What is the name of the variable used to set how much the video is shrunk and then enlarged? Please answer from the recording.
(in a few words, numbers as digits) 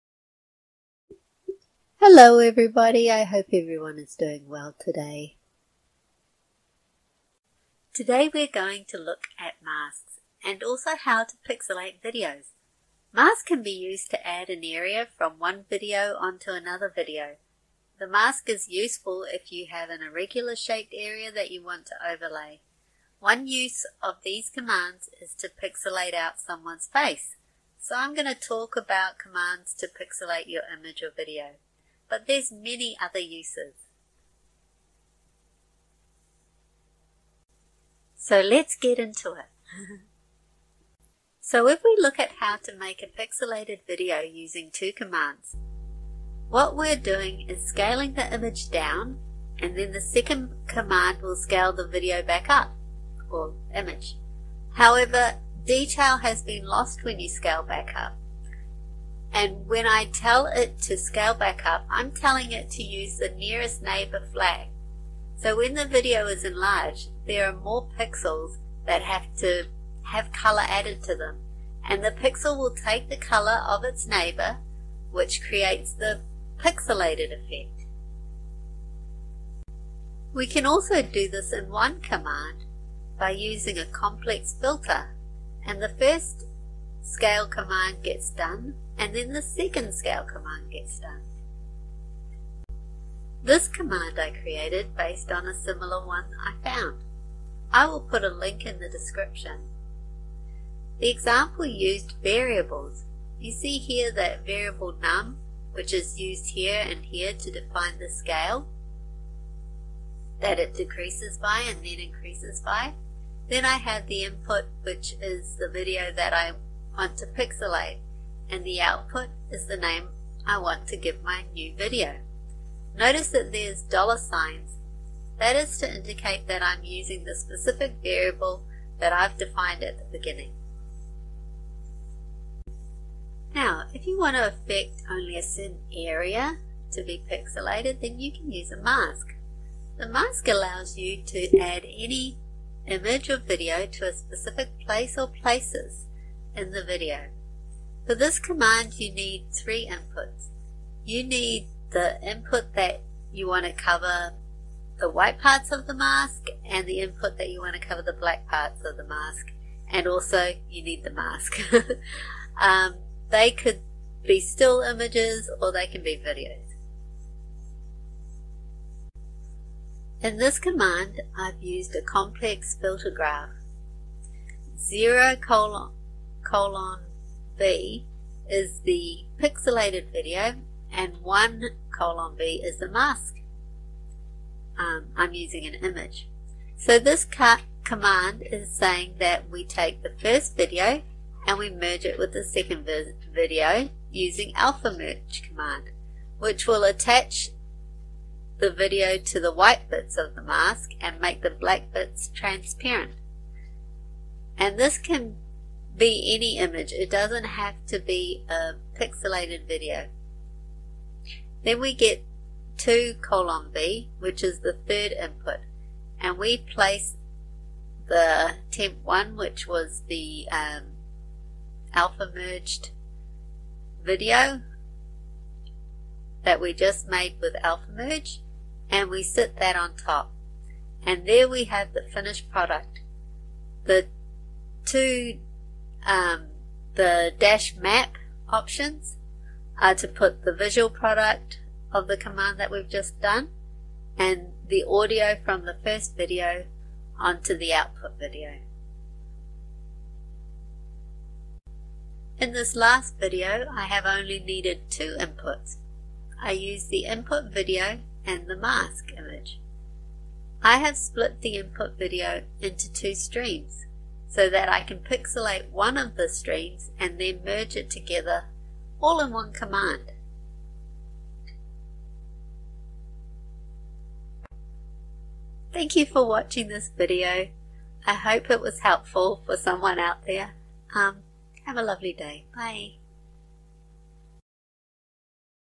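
num.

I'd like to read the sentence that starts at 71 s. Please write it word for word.
And the pixel will take the color of its neighbor, which creates the pixelated effect.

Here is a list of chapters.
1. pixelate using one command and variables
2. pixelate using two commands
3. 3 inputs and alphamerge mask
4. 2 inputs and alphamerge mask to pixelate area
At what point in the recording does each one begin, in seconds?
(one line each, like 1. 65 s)
1. 81 s
2. 42 s
3. 134 s
4. 254 s.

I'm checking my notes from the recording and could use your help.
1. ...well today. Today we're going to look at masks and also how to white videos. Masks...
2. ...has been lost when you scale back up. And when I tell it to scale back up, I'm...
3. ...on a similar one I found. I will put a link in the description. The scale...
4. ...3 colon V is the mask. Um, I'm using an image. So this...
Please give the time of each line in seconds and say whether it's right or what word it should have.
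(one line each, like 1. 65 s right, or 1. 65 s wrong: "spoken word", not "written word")
1. 4 s wrong: "pixelate", not "white"
2. 56 s right
3. 95 s wrong: "example", not "scale"
4. 181 s wrong: "1", not "3".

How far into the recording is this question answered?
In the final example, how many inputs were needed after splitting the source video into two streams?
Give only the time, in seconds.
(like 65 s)
254 s.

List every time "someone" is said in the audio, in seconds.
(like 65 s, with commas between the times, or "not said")
26 s, 279 s.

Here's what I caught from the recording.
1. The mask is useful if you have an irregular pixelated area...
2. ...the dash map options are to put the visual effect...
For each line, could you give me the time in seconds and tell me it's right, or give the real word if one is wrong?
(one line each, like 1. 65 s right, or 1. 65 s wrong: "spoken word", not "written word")
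1. 17 s wrong: "shaped", not "pixelated"
2. 236 s wrong: "product", not "effect".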